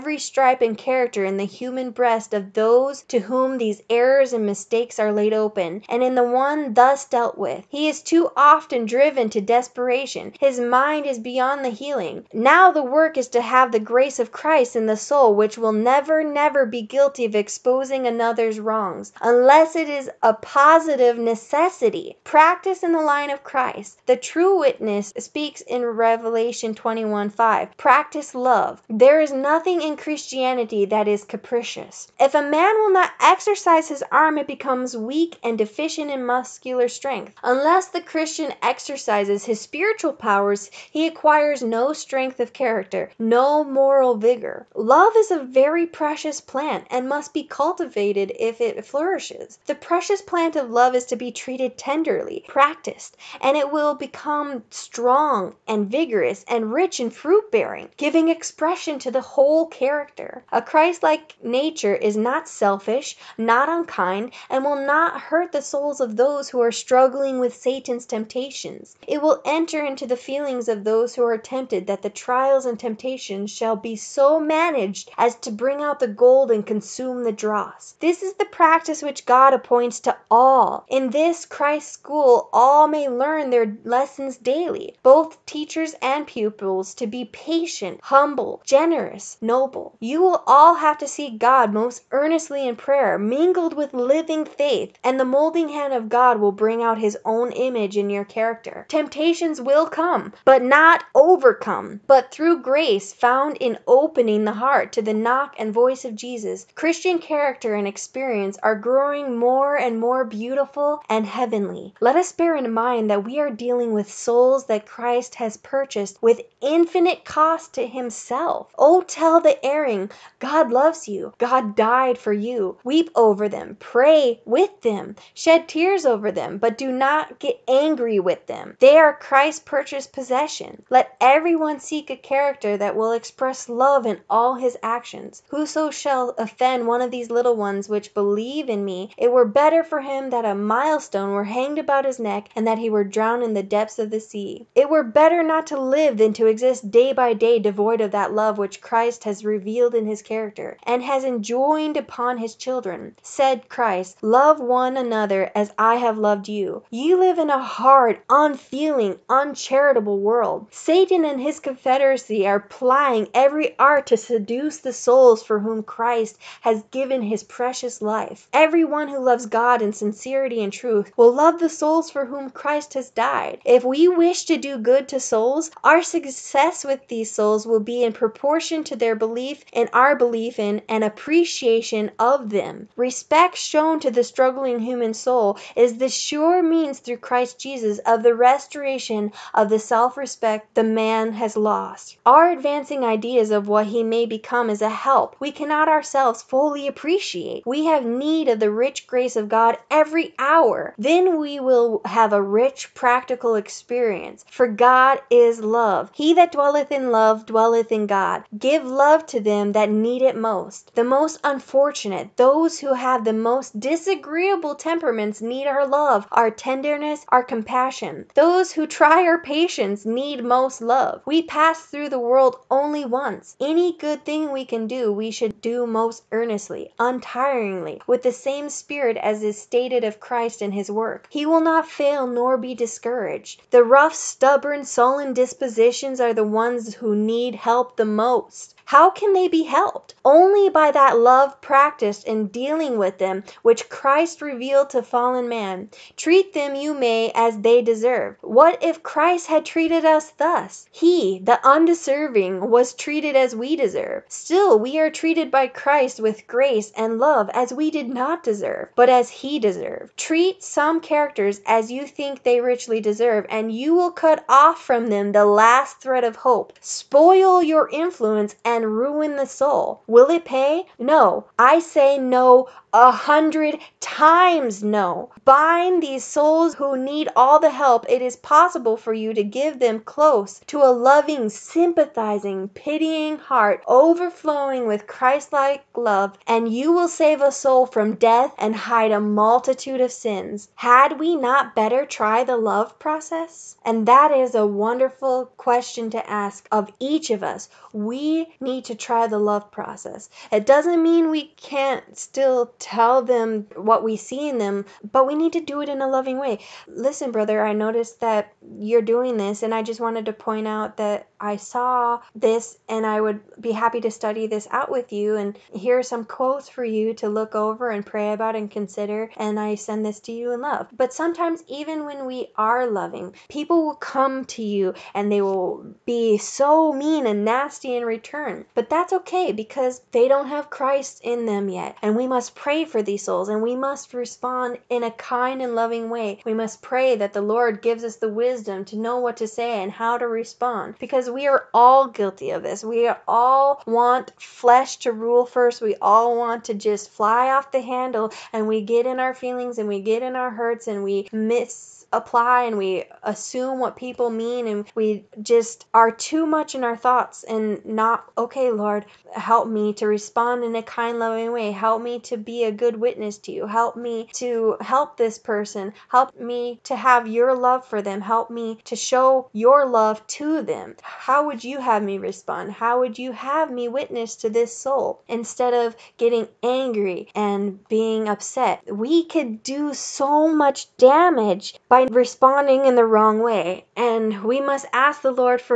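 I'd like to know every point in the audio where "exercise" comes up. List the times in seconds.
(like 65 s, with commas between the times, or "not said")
33 s, 38 s.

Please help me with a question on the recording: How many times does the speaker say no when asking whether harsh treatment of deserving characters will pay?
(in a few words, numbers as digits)
100.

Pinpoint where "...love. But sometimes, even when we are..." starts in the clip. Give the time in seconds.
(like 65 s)
320 s.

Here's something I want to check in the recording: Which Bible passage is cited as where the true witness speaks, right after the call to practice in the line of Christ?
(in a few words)
Revelation 21:5.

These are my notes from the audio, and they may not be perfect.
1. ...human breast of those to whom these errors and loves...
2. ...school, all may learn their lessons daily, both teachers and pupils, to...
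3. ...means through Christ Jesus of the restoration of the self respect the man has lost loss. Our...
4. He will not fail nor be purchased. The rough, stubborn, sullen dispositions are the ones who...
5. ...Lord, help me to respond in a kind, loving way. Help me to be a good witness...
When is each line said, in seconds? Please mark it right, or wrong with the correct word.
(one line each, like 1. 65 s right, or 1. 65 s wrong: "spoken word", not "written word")
1. 1 s wrong: "mistakes", not "loves"
2. 81 s right
3. 186 s right
4. 231 s wrong: "discouraged", not "purchased"
5. 358 s right.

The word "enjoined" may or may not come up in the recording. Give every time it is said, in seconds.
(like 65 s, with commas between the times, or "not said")
151 s.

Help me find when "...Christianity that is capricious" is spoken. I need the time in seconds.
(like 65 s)
29 s.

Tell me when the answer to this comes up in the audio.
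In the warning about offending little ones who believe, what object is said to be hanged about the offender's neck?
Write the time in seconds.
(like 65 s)
140 s.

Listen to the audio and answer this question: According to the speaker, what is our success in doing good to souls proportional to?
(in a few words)
Belief in and appreciation.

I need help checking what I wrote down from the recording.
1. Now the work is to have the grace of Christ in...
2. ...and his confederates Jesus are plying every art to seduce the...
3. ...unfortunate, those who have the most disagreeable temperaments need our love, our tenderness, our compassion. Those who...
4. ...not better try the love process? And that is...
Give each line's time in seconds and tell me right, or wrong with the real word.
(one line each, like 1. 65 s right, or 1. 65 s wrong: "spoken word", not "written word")
1. 12 s right
2. 161 s wrong: "Confederacy", not "Jesus"
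3. 211 s right
4. 291 s right.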